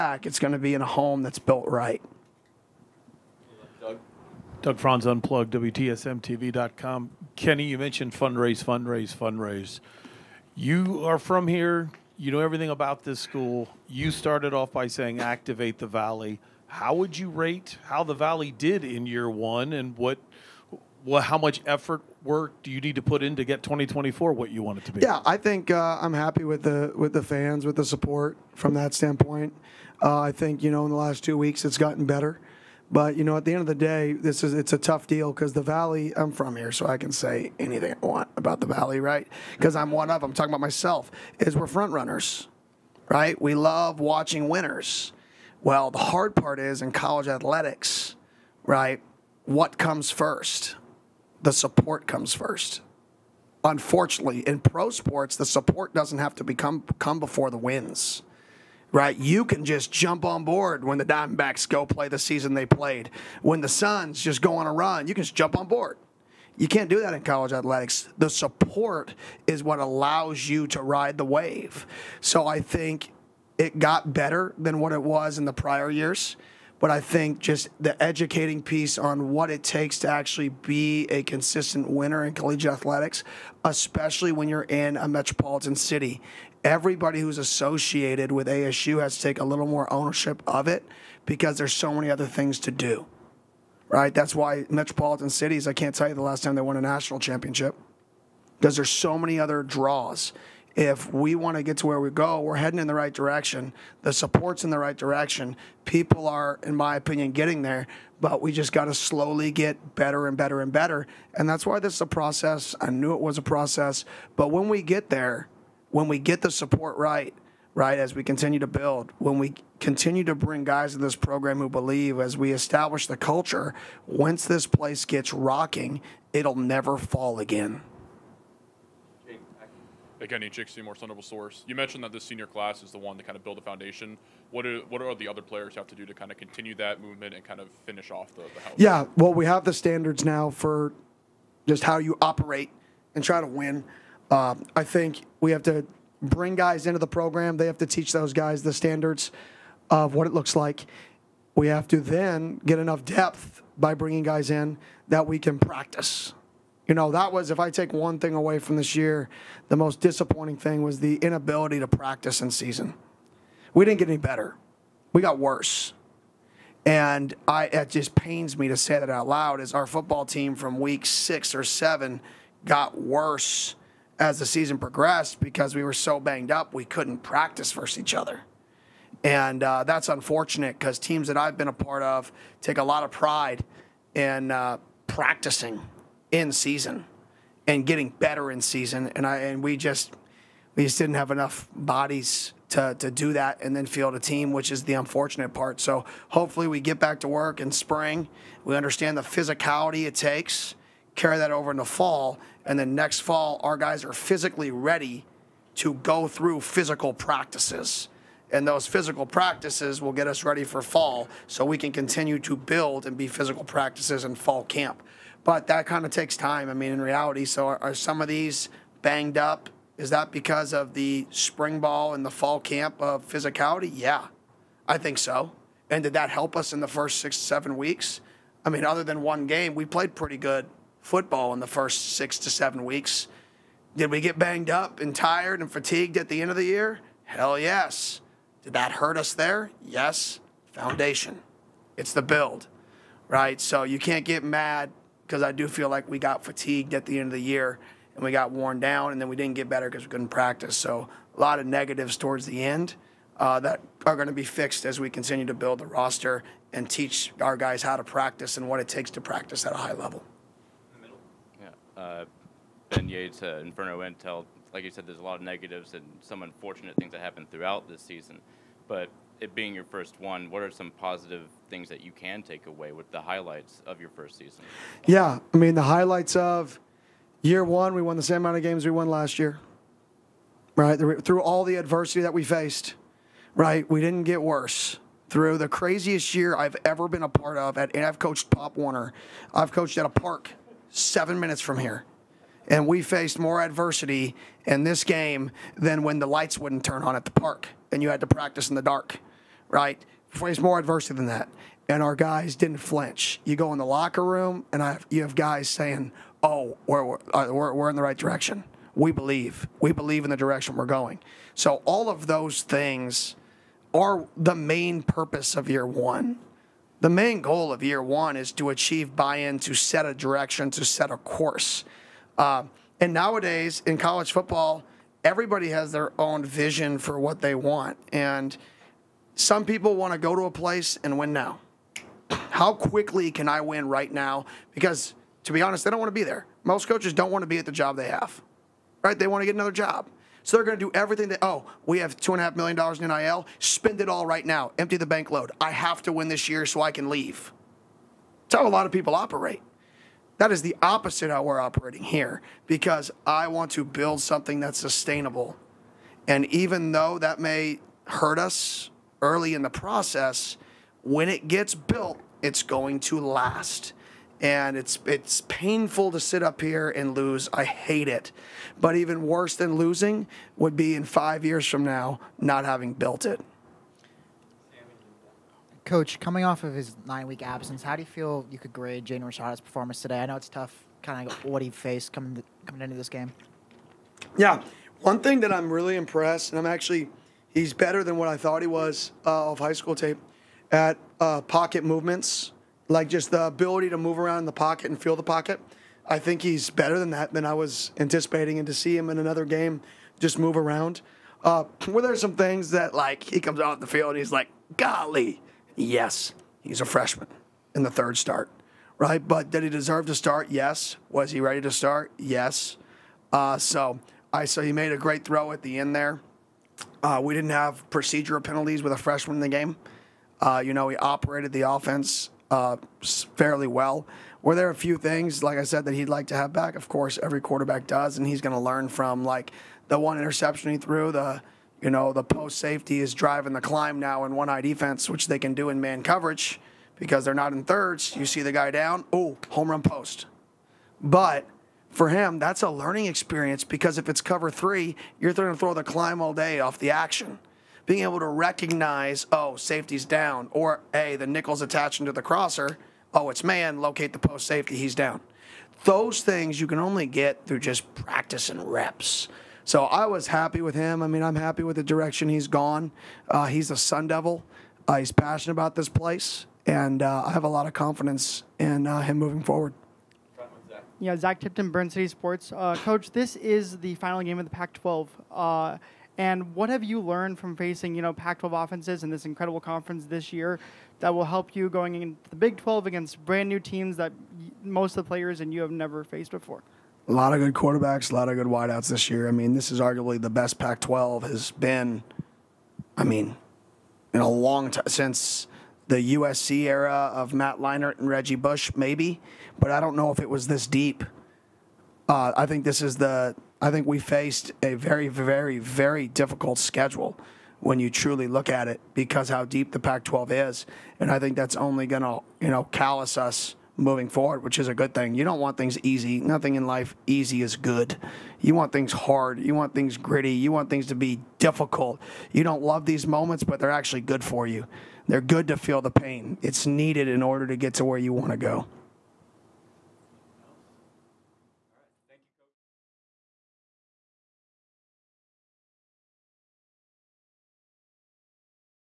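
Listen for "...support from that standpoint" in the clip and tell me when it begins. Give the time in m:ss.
0:27.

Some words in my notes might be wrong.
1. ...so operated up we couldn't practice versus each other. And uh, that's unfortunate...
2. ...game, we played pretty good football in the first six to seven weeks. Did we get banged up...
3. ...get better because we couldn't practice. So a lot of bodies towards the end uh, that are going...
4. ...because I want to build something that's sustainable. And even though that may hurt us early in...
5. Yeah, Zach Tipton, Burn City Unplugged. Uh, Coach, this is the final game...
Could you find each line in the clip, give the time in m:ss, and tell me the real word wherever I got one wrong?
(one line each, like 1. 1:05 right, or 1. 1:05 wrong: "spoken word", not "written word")
1. 2:55 wrong: "banged", not "operated"
2. 3:49 right
3. 4:09 wrong: "negatives", not "bodies"
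4. 5:52 right
5. 7:50 wrong: "Sports", not "Unplugged".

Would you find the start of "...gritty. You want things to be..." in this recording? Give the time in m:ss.
8:39.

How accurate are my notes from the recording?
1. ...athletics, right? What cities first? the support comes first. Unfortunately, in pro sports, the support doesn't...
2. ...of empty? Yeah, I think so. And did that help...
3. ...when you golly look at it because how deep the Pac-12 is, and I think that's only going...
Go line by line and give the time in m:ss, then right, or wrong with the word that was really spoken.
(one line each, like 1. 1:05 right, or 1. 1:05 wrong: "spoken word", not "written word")
1. 0:47 wrong: "comes", not "cities"
2. 3:42 wrong: "physicality", not "empty"
3. 8:27 wrong: "truly", not "golly".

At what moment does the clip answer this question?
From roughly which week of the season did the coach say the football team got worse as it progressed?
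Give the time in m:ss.
2:50.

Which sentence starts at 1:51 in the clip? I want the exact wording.
And that's why this is a process.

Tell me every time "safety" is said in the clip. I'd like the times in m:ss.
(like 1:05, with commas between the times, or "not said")
7:12, 7:29, 7:34.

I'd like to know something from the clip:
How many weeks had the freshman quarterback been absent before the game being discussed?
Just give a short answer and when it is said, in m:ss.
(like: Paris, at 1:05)
9, at 6:17.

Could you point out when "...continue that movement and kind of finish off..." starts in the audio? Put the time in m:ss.
2:16.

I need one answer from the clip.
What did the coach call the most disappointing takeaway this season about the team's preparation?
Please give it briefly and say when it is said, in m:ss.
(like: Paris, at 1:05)
inability to practice in season, at 2:41.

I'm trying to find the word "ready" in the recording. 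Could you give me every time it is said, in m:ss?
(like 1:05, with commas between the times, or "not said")
3:24, 3:30, 6:51.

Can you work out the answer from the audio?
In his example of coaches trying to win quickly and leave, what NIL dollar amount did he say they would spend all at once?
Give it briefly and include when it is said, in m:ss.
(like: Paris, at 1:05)
$2.5 million, at 5:42.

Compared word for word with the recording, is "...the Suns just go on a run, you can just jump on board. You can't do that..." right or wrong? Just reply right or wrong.
right.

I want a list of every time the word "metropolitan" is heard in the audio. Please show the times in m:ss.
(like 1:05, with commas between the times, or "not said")
1:25, 1:34.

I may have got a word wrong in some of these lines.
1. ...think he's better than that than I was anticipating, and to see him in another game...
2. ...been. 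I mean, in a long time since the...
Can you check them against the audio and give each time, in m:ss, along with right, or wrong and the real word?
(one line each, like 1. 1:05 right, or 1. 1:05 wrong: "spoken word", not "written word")
1. 6:36 right
2. 8:11 right.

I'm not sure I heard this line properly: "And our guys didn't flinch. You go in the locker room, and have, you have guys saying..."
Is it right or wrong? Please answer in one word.
right.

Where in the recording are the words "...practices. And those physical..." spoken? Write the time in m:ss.
3:27.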